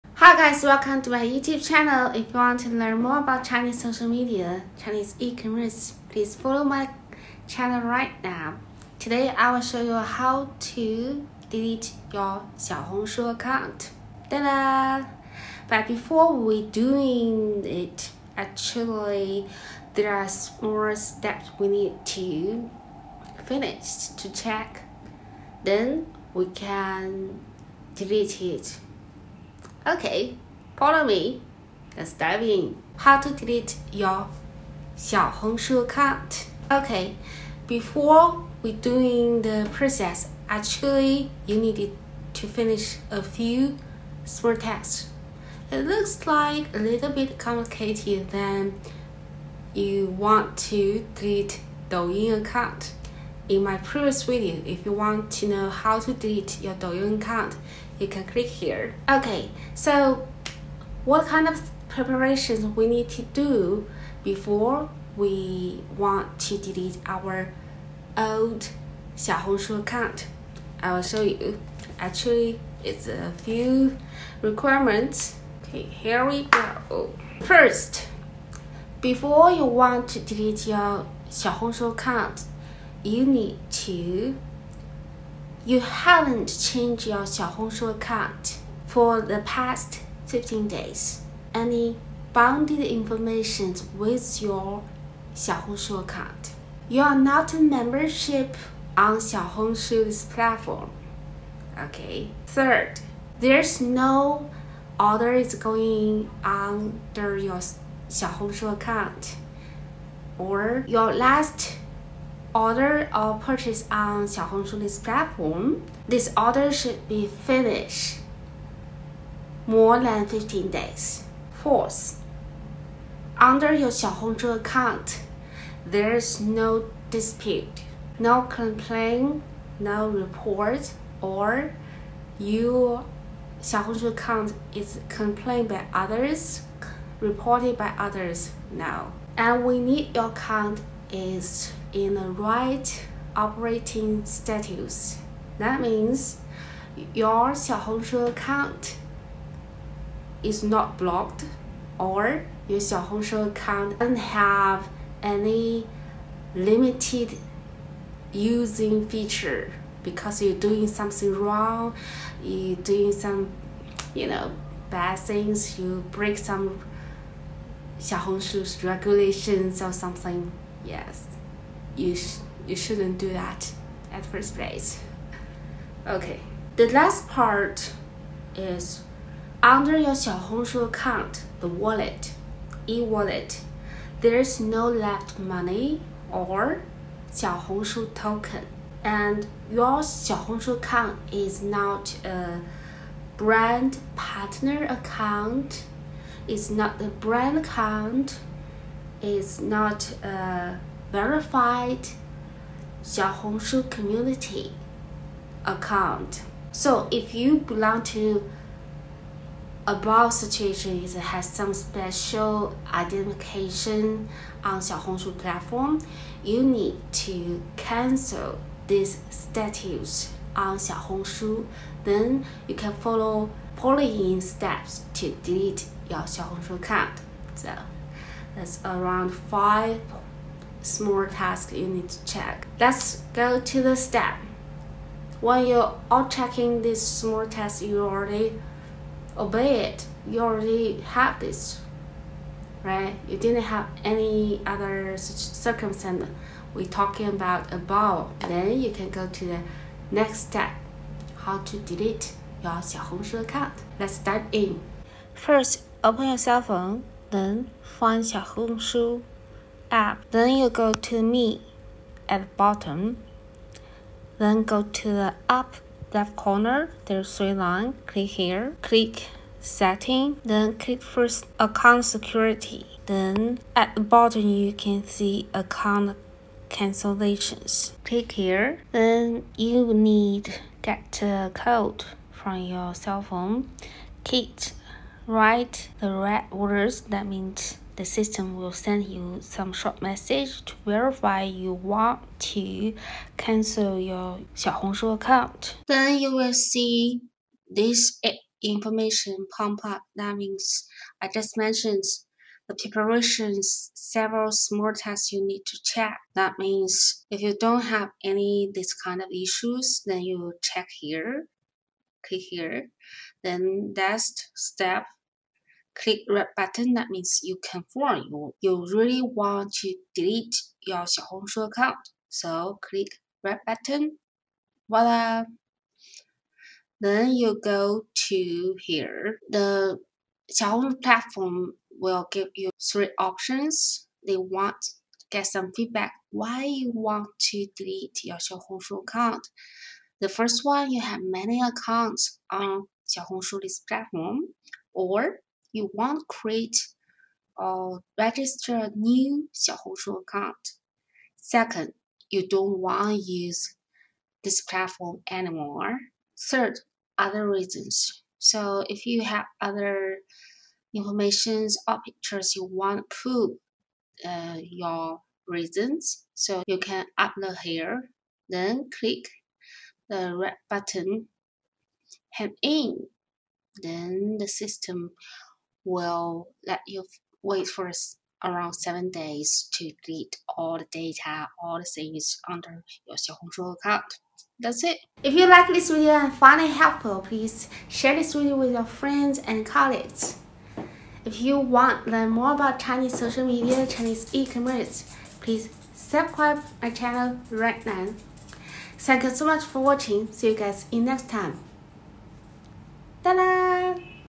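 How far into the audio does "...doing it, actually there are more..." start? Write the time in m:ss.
0:16.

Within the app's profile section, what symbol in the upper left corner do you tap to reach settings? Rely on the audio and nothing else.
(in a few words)
three lines.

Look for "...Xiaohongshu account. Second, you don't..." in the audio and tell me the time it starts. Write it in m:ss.
5:49.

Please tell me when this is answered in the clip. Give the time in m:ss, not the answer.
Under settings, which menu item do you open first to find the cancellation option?
4:31.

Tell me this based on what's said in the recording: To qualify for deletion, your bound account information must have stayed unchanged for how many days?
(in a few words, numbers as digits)
15 days.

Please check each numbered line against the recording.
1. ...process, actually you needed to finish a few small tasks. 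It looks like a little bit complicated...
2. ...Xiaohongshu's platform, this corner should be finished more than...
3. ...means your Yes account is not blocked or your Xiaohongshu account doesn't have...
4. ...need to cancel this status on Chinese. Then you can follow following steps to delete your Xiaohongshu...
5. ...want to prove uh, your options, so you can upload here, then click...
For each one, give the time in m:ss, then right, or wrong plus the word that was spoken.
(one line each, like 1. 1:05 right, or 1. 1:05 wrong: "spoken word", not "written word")
1. 0:39 right
2. 1:54 wrong: "order", not "corner"
3. 2:25 wrong: "Xiaohongshu", not "Yes"
4. 3:36 wrong: "Xiaohongshu", not "Chinese"
5. 6:02 wrong: "reasons", not "options".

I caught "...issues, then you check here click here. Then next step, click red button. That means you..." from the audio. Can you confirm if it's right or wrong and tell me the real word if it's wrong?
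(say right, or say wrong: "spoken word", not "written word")
right.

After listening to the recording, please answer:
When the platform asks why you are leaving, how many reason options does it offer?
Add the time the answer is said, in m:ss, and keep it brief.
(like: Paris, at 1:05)
3, at 5:32.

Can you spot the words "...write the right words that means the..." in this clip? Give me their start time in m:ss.
4:45.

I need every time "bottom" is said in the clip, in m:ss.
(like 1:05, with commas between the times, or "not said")
4:22, 4:34.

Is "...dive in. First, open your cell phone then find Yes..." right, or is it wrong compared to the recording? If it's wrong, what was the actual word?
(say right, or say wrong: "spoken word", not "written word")
wrong: "Xiaohongshu", not "Yes".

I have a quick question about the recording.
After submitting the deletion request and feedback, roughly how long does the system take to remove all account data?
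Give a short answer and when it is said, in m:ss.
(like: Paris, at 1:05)
7 days, at 6:18.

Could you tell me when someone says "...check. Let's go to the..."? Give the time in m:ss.
3:52.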